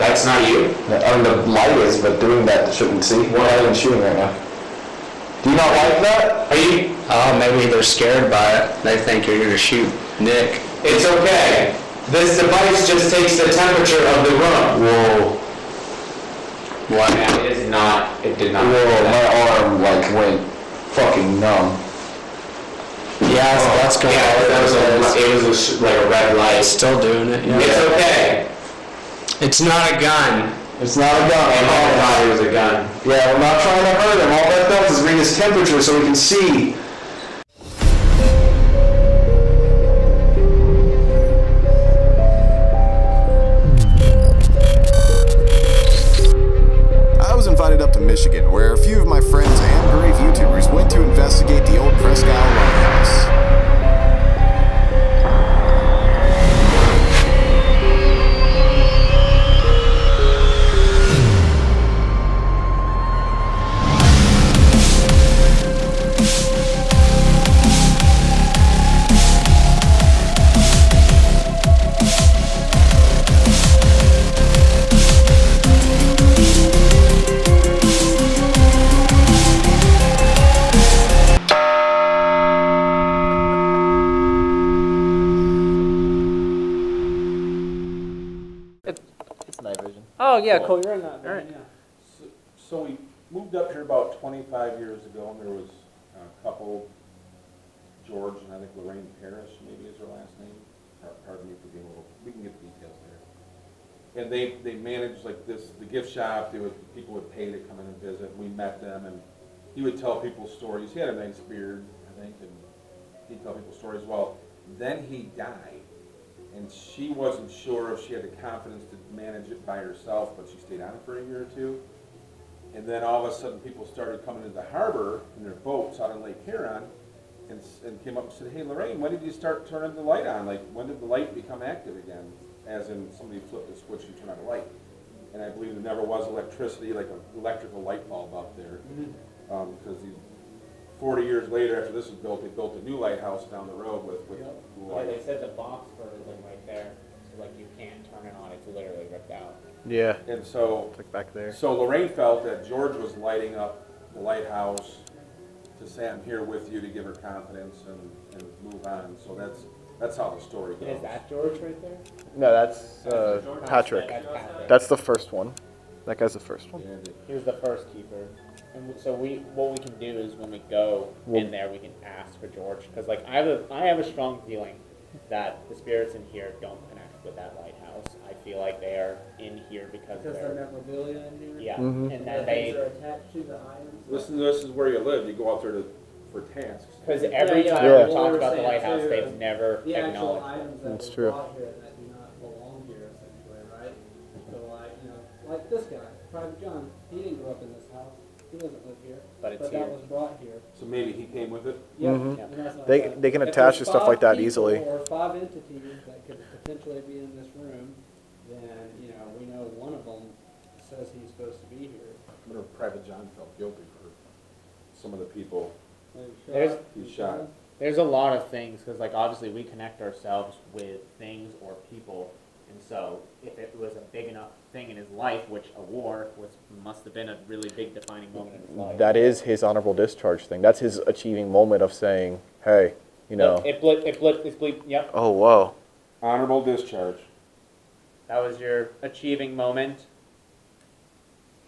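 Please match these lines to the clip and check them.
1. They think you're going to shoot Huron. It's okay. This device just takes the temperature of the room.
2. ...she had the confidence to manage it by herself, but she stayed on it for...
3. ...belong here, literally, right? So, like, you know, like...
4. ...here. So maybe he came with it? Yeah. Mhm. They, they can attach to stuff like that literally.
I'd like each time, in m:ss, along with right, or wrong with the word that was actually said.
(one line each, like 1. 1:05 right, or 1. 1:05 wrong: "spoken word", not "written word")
1. 0:08 wrong: "Nick", not "Huron"
2. 1:58 right
3. 3:12 wrong: "essentially", not "literally"
4. 3:20 wrong: "easily", not "literally".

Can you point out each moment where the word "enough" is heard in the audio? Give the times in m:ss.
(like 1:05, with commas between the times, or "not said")
3:44.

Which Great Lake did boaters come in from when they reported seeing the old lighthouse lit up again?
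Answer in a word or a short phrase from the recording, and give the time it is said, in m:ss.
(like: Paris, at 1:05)
Lake Huron, at 2:06.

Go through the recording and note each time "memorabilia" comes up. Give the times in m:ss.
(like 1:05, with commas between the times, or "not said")
3:00.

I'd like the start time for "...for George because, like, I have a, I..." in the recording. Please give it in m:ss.
2:52.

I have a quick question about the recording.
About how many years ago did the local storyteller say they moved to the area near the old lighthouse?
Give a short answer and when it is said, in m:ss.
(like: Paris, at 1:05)
25, at 1:34.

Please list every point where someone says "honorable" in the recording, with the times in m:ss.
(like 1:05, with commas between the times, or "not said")
3:49, 3:56.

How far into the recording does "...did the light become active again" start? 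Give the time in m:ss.
2:10.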